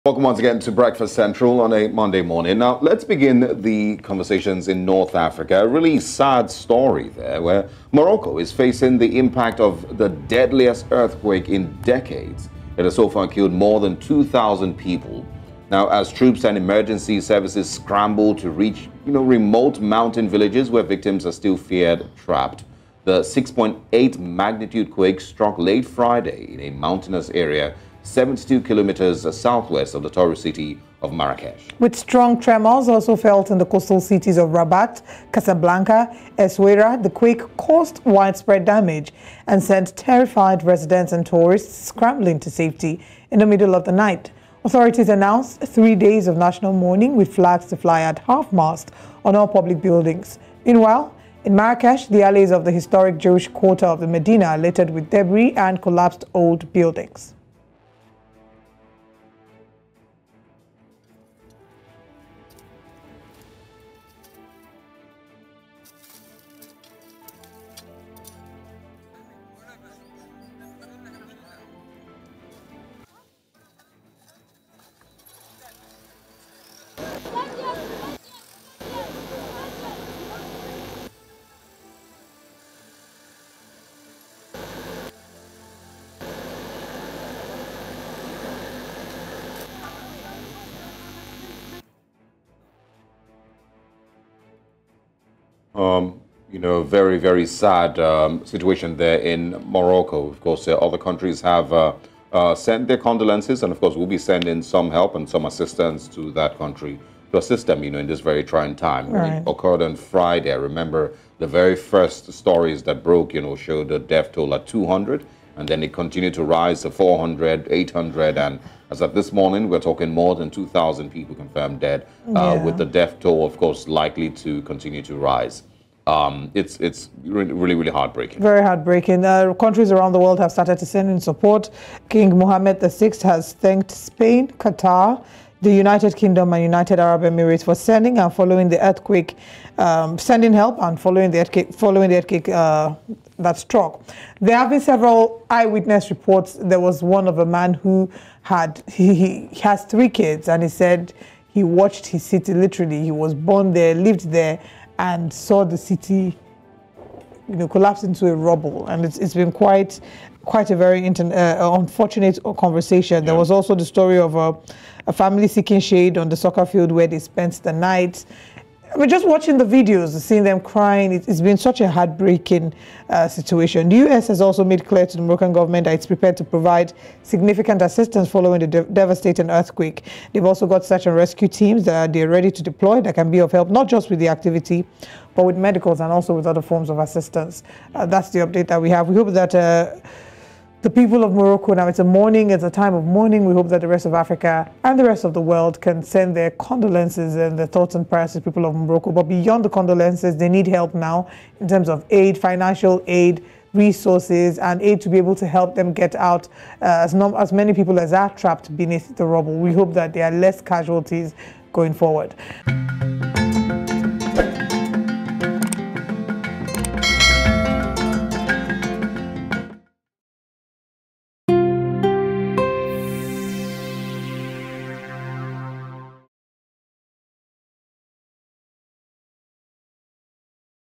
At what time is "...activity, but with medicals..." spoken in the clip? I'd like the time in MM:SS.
03:04.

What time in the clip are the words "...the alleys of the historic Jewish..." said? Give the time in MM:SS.
00:52.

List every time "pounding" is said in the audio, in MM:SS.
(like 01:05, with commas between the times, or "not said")
not said.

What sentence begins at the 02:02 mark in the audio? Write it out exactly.
with the death toll, of course, likely to continue to rise.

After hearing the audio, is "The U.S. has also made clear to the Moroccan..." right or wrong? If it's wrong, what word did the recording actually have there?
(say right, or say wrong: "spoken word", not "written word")
right.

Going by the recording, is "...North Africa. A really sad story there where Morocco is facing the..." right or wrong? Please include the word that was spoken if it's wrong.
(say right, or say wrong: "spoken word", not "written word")
right.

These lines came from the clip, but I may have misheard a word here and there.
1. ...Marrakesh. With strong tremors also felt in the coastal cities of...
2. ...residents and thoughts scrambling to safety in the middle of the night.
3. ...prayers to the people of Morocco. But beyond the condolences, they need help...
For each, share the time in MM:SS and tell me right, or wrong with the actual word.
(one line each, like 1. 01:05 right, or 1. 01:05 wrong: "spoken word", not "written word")
1. 00:31 right
2. 00:40 wrong: "tourists", not "thoughts"
3. 03:18 right.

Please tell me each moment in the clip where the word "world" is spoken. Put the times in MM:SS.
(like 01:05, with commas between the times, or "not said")
02:10, 03:15.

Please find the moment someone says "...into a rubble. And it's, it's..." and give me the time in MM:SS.
02:38.